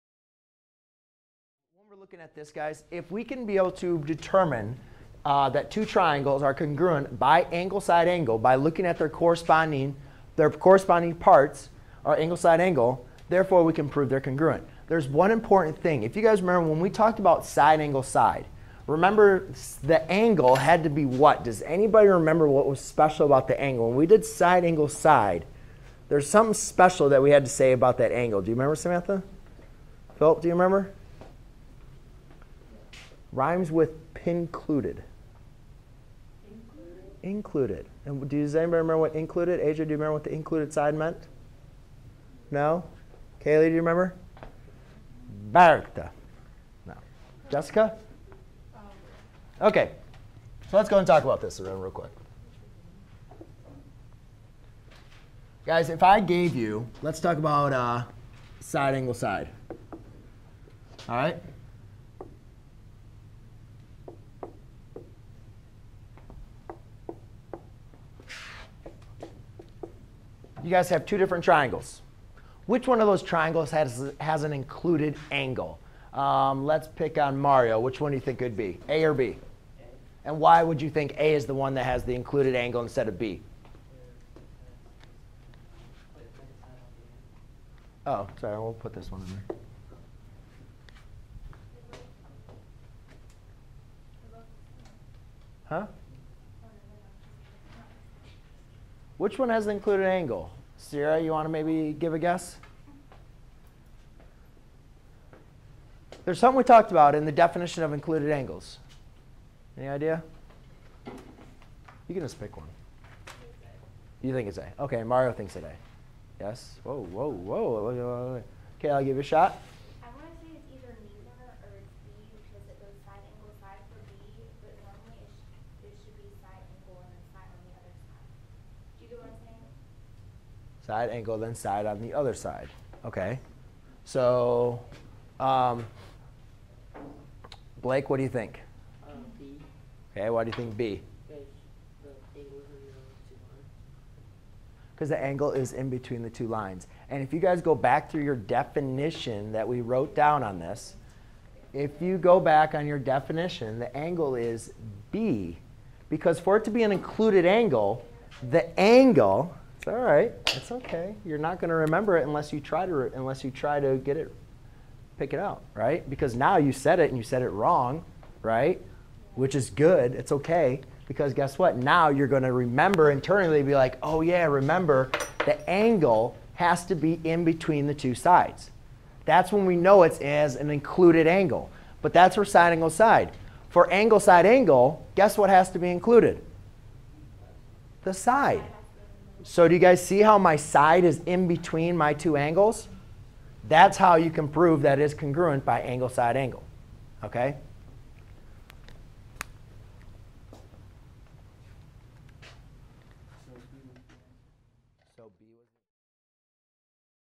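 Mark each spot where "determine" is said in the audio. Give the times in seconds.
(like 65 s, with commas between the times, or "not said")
4 s.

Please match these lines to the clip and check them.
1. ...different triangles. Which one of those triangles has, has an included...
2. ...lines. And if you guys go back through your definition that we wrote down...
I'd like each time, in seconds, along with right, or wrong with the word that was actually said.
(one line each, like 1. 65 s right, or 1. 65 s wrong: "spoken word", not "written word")
1. 71 s right
2. 146 s right.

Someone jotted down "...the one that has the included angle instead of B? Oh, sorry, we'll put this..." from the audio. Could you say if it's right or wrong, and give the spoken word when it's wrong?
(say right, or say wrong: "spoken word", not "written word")
right.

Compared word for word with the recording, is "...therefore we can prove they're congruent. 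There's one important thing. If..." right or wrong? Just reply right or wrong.
right.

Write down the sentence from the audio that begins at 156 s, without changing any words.
Because for it to be an included angle, the angle it's all right.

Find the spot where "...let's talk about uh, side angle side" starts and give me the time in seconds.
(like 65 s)
57 s.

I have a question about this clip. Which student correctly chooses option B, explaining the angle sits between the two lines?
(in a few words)
Blake.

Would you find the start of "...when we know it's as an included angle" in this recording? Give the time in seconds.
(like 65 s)
179 s.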